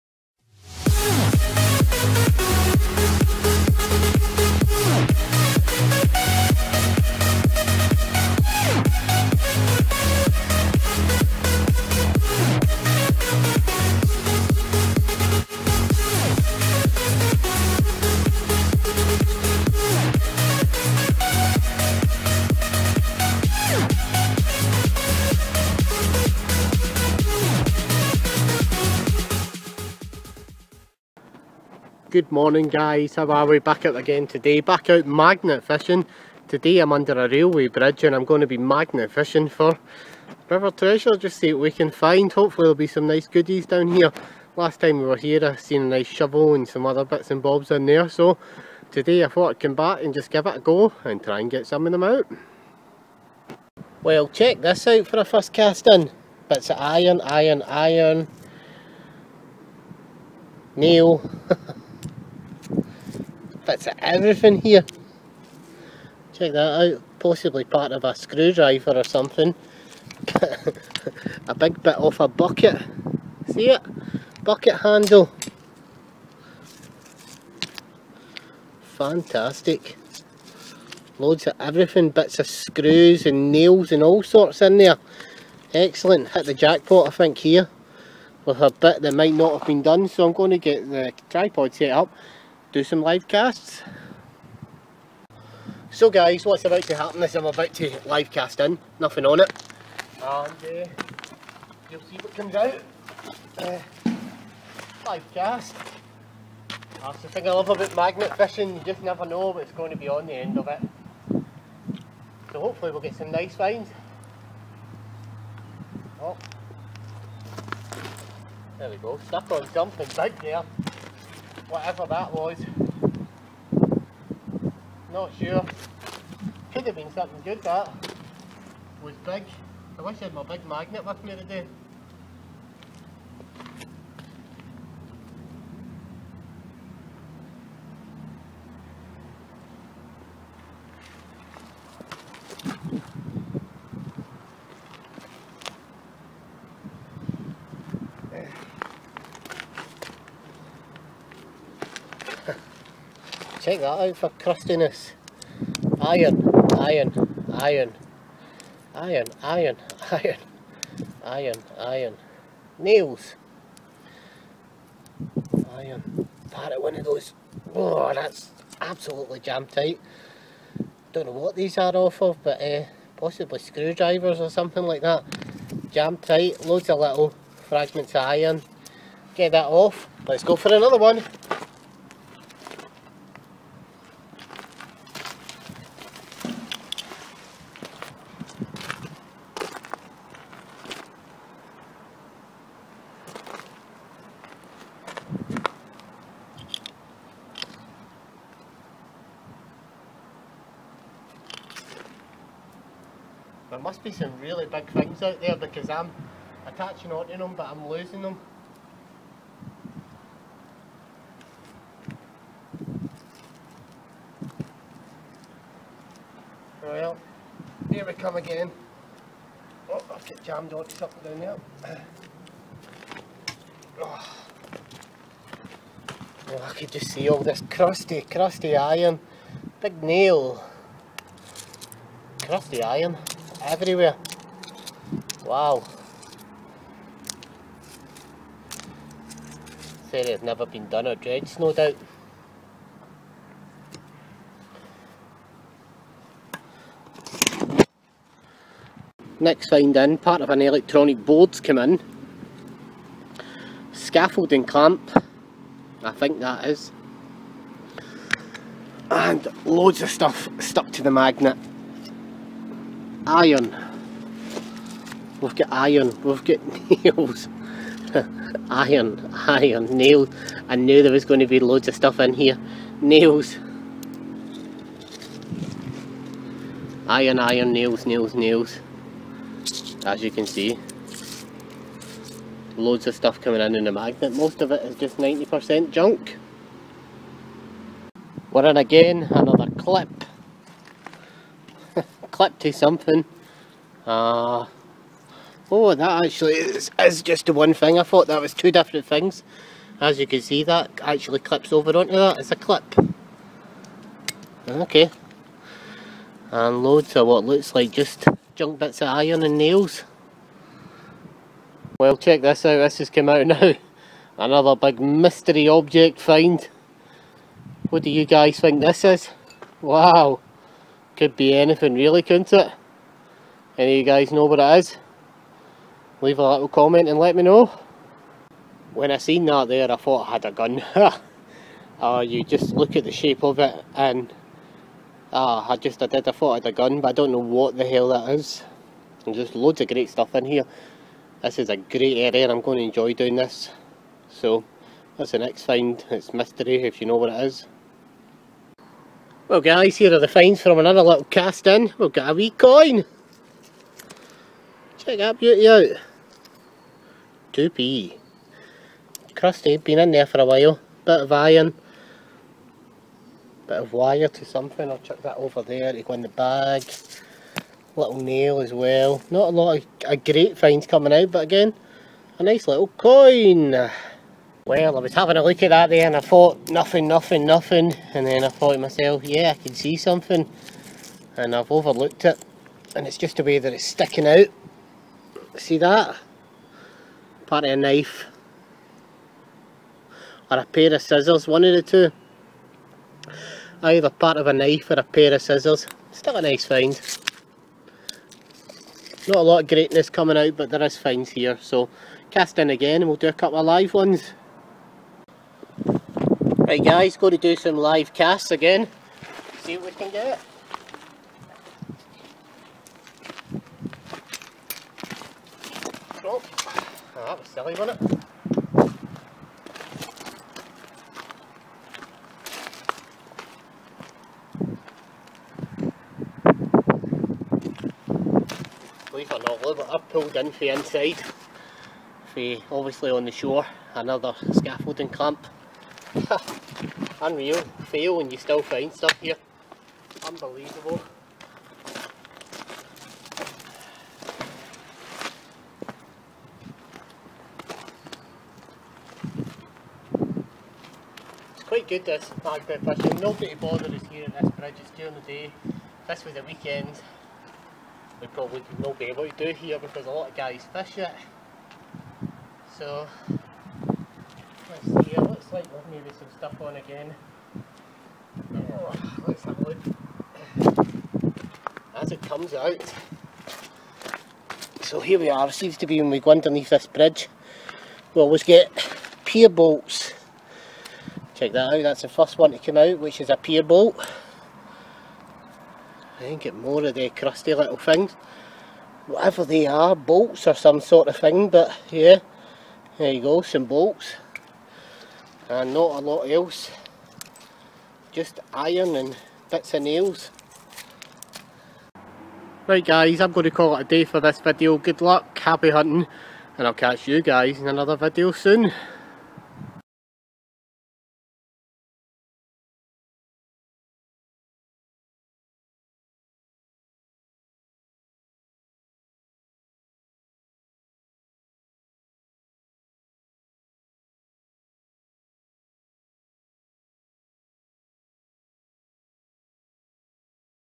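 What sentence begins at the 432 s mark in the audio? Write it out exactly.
For obviously on the shore, another scaffolding clamp.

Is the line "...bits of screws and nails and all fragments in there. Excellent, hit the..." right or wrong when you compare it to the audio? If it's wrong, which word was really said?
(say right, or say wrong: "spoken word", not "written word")
wrong: "sorts", not "fragments".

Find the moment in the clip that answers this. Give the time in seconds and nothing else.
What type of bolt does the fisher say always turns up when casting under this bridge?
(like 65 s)
479 s.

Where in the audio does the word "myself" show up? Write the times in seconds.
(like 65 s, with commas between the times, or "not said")
378 s.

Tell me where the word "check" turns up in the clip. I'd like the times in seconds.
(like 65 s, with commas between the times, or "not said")
54 s, 66 s, 153 s, 312 s, 354 s, 481 s.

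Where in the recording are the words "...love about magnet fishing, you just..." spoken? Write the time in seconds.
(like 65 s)
107 s.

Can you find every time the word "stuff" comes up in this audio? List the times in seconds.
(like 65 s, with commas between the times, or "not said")
260 s, 271 s, 283 s, 340 s, 438 s, 466 s.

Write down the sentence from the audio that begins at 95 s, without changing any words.
So guys, what's about to happen is I'm about to live cast in, nothing on it.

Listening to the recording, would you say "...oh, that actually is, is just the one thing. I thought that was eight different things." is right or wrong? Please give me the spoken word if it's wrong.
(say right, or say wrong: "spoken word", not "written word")
wrong: "two", not "eight".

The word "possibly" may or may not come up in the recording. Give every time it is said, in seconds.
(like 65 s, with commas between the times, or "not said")
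67 s, 173 s.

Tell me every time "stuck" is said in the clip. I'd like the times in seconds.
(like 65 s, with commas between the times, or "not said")
119 s, 260 s.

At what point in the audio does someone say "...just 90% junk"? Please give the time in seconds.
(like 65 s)
284 s.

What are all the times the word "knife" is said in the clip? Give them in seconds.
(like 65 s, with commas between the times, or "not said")
387 s, 394 s.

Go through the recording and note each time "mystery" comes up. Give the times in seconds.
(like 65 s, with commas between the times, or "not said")
314 s, 346 s.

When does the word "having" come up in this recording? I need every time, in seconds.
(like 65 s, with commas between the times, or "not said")
375 s.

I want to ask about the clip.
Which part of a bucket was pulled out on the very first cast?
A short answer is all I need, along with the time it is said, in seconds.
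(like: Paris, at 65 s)
Bucket handle, at 74 s.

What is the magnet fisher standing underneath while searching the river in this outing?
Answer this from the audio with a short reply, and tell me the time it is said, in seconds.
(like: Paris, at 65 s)
A railway bridge, at 37 s.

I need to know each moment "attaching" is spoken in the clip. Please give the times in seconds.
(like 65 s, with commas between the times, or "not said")
206 s.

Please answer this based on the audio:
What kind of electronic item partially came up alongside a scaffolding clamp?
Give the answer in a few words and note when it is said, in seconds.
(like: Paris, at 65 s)
Electronic board, at 250 s.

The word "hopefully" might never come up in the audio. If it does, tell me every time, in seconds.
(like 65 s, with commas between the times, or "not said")
42 s, 112 s.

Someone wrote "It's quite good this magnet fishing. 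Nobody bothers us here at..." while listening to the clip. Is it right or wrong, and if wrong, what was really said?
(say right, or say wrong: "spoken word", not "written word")
right.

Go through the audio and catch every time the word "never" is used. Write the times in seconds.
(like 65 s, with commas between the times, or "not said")
109 s, 240 s.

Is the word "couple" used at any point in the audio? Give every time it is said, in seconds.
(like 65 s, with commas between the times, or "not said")
403 s.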